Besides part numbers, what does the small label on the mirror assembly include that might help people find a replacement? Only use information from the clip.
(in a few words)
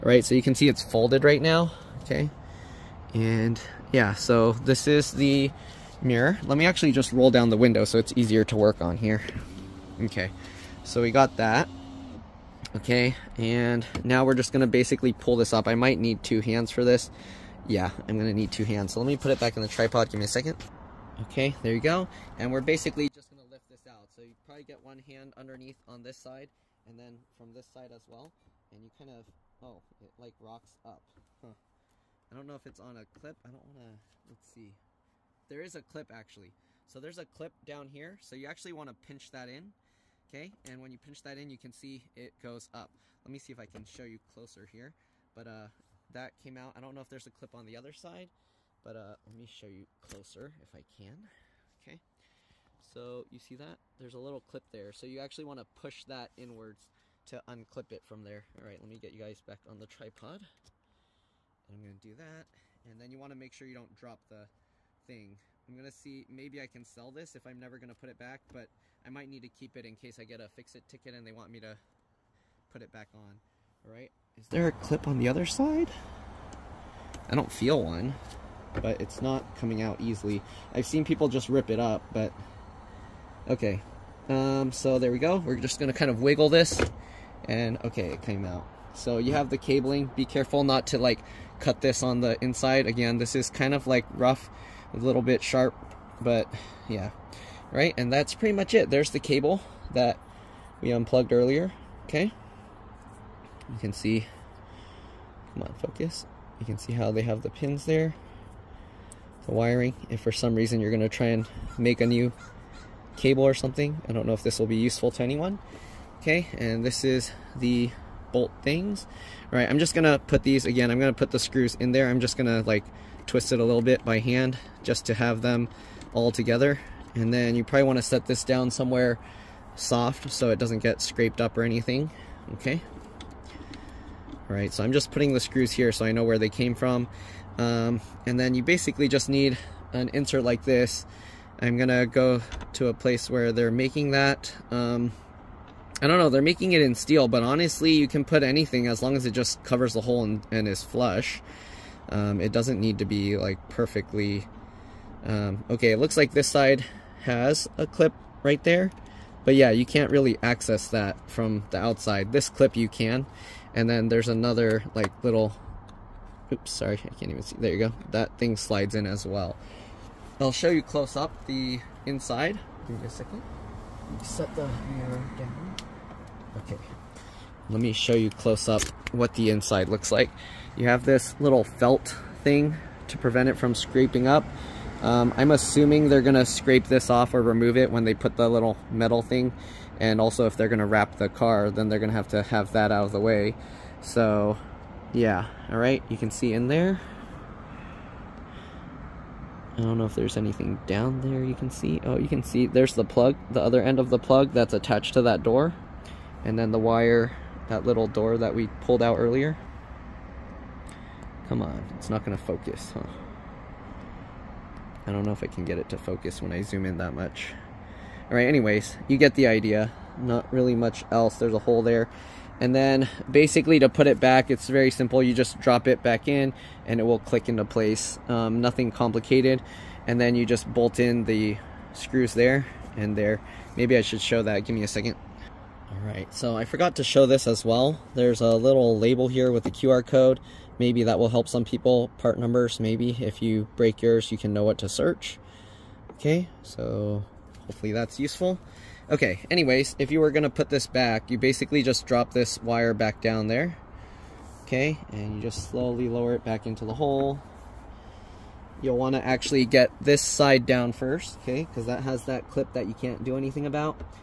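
QR code.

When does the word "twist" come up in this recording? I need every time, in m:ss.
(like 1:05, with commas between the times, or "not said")
2:03.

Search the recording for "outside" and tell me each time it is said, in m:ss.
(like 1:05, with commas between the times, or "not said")
2:41.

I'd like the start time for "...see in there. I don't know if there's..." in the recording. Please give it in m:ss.
3:16.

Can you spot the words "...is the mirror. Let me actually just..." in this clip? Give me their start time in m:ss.
0:04.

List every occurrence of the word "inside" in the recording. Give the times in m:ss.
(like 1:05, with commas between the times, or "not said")
1:32, 2:52, 2:59.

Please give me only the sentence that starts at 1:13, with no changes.
All right, is there a clip on the other side?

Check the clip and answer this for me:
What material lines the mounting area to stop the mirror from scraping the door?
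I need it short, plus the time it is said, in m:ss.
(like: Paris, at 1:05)
felt, at 3:01.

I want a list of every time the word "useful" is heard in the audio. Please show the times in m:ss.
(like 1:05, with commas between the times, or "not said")
1:54, 4:08.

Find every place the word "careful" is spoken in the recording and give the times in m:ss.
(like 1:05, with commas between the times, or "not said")
1:30.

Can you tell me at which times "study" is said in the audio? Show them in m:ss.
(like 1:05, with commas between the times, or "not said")
not said.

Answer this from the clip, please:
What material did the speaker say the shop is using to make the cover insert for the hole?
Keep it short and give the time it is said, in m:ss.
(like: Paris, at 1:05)
steel, at 2:26.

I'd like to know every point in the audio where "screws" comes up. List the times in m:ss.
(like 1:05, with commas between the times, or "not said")
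2:01, 2:15, 3:51.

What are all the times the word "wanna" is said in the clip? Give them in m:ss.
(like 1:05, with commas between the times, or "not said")
0:33, 0:38, 2:07.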